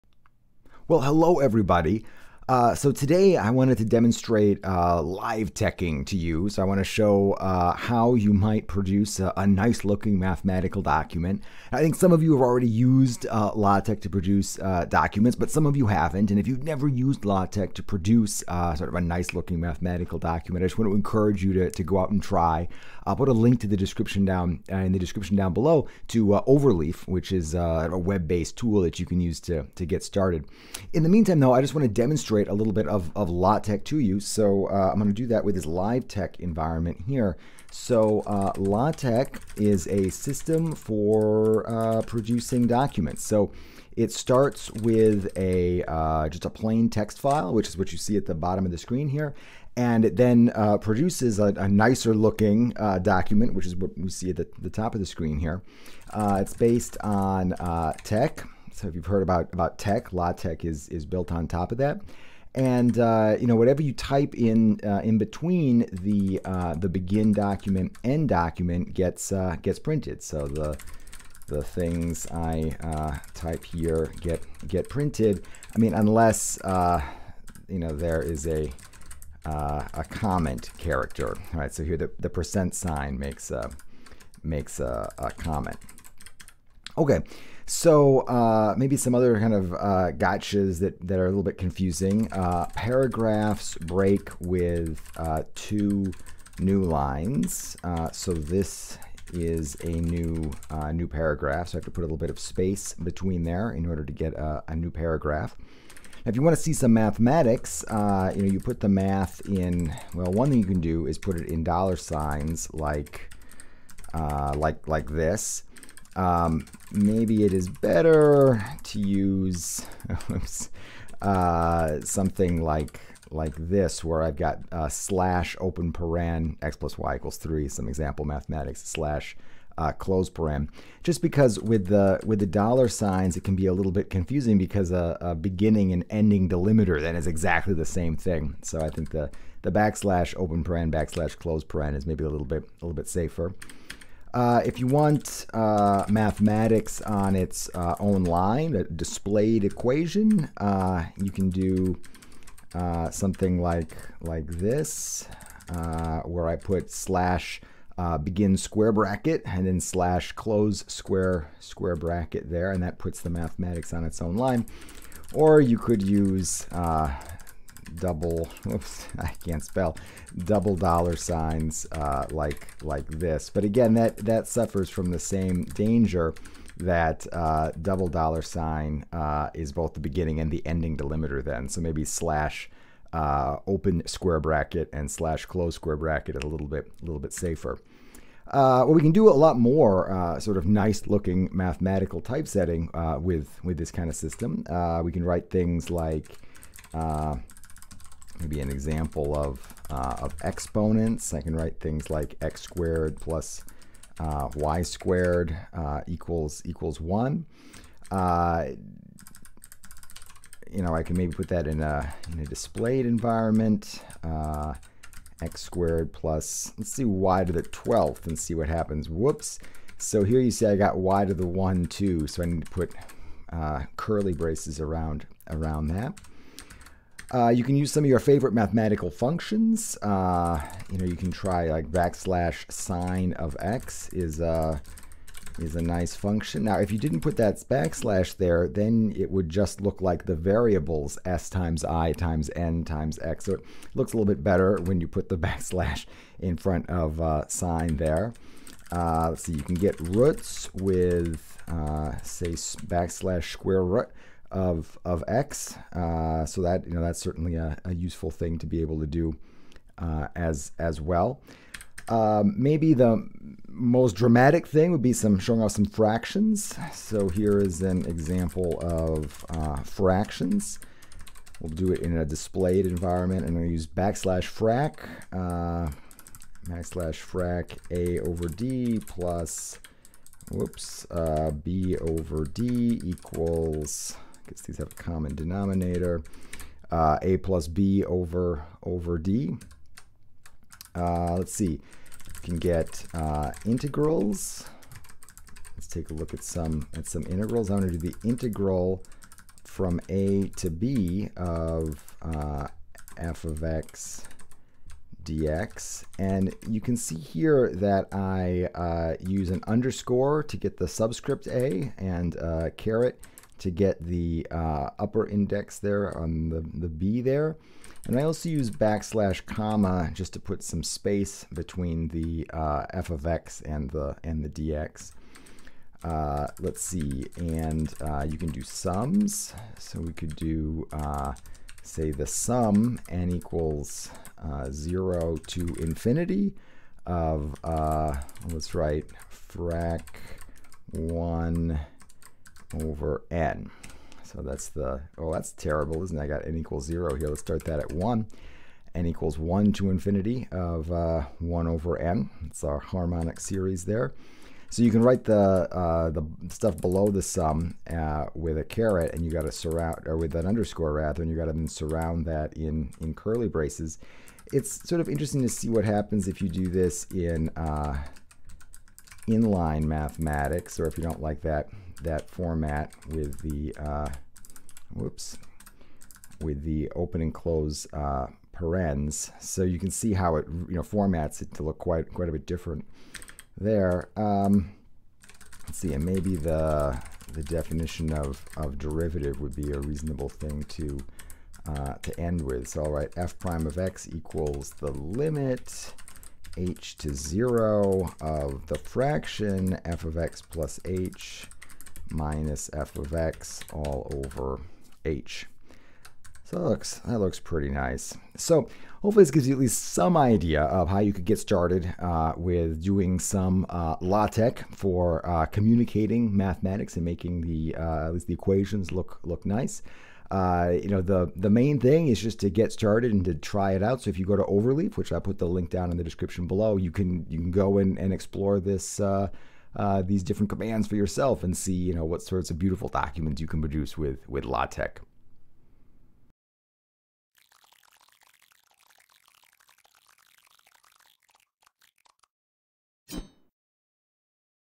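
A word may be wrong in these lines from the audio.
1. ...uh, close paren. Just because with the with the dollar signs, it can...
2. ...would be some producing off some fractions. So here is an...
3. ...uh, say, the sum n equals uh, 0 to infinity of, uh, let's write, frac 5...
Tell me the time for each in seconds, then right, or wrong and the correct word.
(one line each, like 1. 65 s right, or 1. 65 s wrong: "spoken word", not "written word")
1. 129 s right
2. 264 s wrong: "showing", not "producing"
3. 330 s wrong: "1", not "5".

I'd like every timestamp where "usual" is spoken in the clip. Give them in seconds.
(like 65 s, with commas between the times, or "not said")
not said.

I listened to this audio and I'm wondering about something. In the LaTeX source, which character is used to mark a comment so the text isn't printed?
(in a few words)
percent sign.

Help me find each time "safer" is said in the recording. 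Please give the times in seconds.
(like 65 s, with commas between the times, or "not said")
143 s, 187 s.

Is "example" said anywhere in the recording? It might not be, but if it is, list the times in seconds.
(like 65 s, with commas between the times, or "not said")
127 s, 198 s, 268 s.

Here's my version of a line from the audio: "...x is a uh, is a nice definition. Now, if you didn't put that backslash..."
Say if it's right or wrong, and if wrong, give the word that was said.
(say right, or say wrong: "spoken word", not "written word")
wrong: "function", not "definition".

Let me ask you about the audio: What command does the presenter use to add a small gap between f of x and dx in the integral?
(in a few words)
backslash comma.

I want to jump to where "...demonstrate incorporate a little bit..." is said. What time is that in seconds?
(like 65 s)
31 s.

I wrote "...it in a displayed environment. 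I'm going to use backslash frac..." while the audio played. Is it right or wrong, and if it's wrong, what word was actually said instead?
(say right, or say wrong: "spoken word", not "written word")
right.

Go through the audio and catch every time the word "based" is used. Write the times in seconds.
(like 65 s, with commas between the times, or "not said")
27 s, 56 s.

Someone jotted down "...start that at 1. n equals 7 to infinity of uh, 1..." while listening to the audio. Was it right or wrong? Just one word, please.
wrong.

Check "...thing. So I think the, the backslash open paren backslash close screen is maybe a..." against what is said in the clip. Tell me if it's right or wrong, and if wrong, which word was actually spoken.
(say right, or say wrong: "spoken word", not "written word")
wrong: "paren", not "screen".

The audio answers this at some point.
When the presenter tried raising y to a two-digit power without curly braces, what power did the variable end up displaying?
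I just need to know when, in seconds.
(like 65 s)
217 s.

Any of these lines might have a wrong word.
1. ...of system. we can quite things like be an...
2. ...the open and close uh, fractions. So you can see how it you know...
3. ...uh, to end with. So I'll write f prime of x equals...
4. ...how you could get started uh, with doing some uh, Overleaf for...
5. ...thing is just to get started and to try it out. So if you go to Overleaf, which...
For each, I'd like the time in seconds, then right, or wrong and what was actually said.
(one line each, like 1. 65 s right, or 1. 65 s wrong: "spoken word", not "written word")
1. 194 s wrong: "write", not "quite"
2. 376 s wrong: "parens", not "fractions"
3. 391 s right
4. 410 s wrong: "LaTeX", not "Overleaf"
5. 421 s right.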